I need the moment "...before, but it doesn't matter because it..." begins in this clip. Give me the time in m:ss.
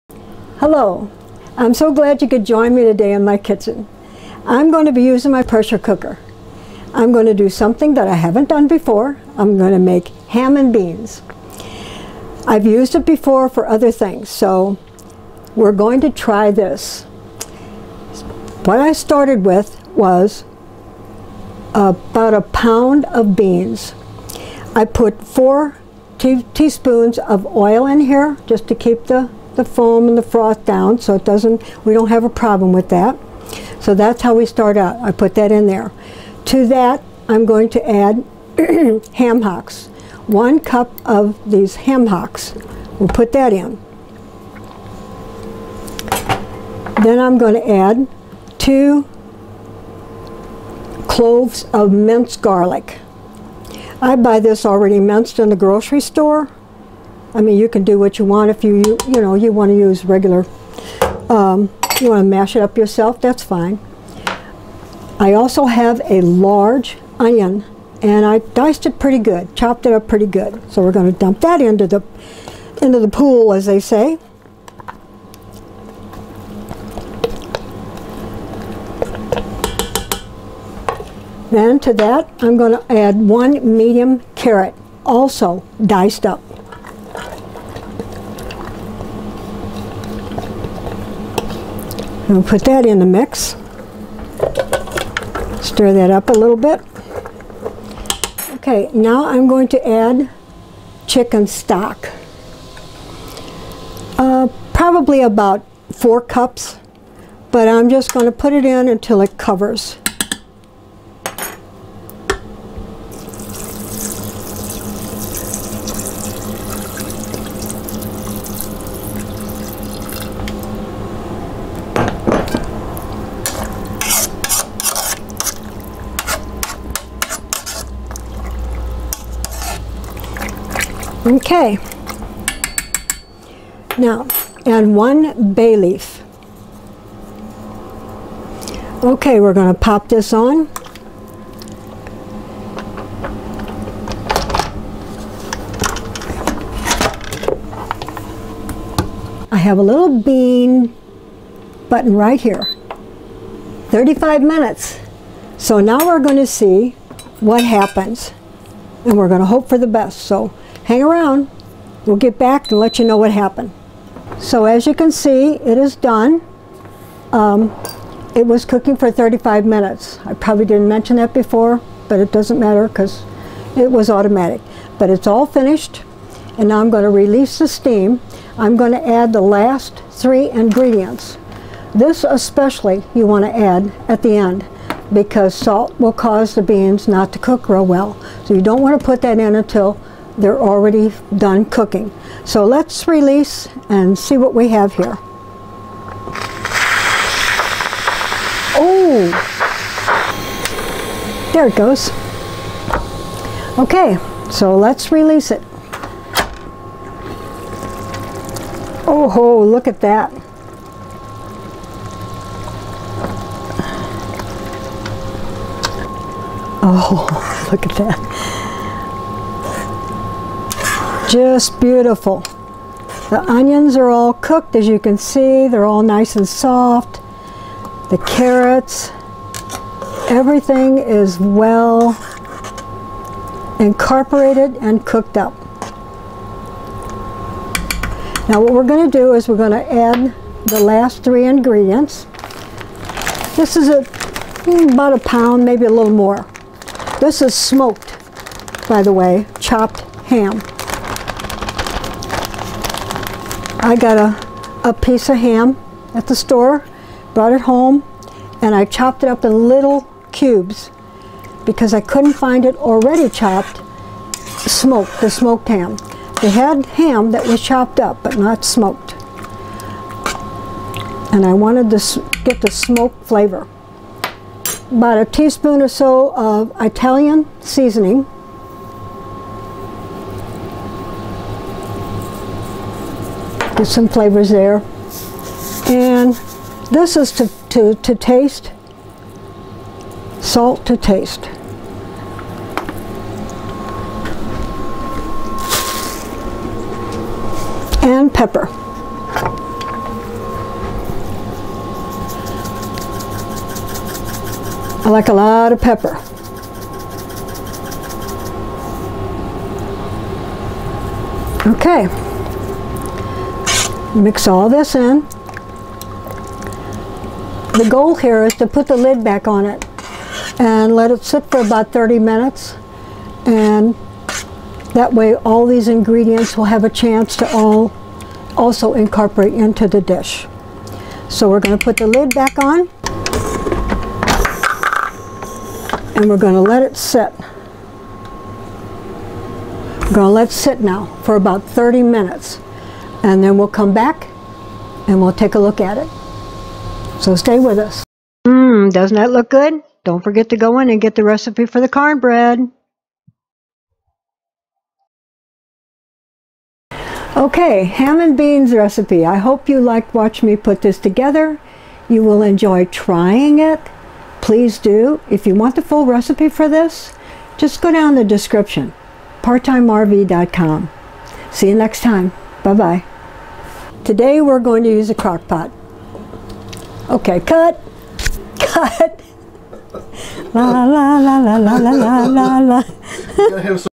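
2:51.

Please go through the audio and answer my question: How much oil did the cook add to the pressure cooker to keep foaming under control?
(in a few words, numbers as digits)
4 teaspoons.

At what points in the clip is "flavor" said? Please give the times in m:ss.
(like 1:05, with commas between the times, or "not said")
4:33, 4:44.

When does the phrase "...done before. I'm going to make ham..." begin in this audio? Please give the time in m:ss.
0:08.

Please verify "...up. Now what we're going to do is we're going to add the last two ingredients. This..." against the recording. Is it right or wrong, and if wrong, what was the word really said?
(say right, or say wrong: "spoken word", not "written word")
wrong: "three", not "two".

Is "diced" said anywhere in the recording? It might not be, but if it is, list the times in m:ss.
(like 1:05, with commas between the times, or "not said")
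1:08, 1:25.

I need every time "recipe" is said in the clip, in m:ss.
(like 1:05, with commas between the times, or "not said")
5:51, 5:58, 6:06.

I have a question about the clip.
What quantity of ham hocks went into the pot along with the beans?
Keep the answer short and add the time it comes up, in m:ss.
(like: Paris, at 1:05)
1 cup, at 0:40.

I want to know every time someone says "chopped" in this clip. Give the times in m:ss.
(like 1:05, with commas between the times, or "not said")
1:09, 4:09, 4:18, 4:23, 4:27.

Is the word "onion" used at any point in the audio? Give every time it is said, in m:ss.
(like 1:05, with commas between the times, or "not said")
1:07, 3:43.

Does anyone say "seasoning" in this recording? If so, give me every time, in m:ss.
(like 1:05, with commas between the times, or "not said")
4:37.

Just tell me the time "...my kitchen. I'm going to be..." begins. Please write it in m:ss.
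0:03.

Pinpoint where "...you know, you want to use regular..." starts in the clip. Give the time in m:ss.
0:59.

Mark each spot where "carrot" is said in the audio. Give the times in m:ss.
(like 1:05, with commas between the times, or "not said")
1:24, 3:48.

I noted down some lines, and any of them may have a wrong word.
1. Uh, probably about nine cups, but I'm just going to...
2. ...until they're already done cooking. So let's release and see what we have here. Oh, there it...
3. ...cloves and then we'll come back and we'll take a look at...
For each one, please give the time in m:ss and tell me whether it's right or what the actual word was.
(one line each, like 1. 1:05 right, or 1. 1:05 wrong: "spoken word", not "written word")
1. 1:44 wrong: "four", not "nine"
2. 3:09 right
3. 5:42 wrong: "minutes", not "cloves".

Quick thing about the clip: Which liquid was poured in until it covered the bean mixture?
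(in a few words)
chicken stock.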